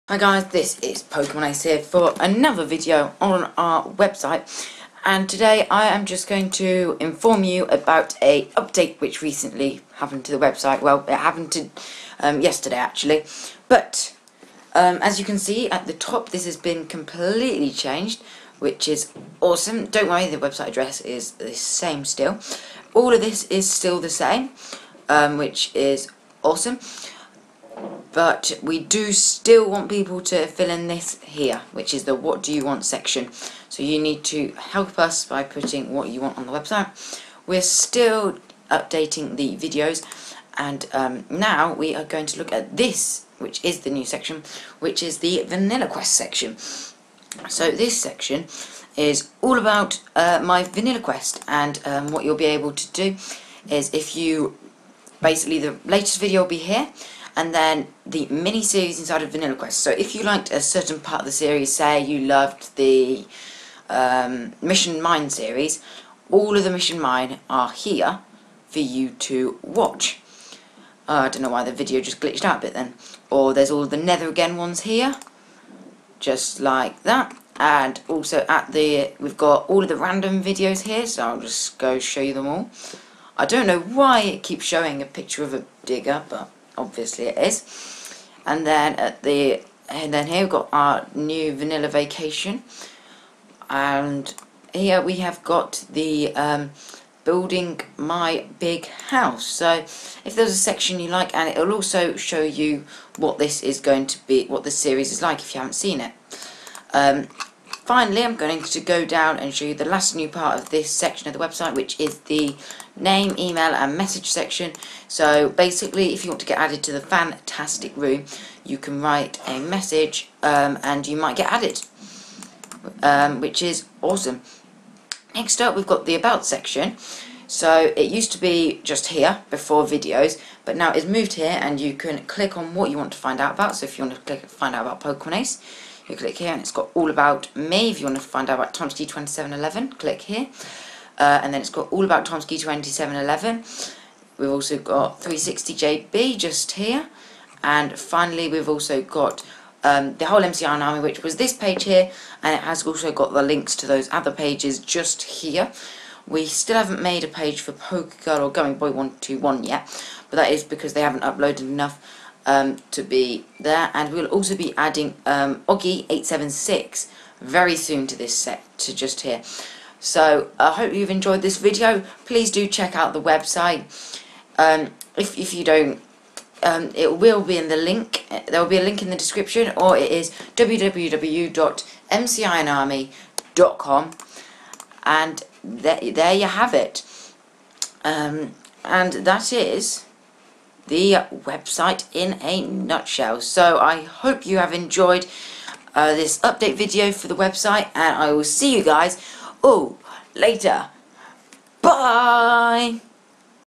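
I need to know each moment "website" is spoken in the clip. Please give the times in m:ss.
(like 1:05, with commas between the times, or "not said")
0:03, 0:10, 0:20, 0:36, 1:51, 2:53, 3:11, 3:17.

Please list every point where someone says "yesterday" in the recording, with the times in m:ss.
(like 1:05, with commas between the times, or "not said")
0:12.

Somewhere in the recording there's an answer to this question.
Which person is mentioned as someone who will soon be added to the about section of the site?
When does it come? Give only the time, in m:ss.
2:45.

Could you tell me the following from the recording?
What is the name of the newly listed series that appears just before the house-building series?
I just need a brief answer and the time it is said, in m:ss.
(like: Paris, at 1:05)
Vanilla Vacation, at 1:31.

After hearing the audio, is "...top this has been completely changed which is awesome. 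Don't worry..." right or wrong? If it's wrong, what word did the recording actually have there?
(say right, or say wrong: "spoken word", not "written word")
right.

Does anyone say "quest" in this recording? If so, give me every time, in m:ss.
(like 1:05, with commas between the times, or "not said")
0:45, 0:50, 0:59.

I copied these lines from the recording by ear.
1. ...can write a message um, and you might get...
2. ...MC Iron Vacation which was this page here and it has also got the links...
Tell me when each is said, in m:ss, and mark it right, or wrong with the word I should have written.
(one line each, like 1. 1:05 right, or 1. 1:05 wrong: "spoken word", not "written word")
1. 1:58 right
2. 2:30 wrong: "Army", not "Vacation".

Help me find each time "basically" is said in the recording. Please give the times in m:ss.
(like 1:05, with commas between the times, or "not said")
0:55, 1:55.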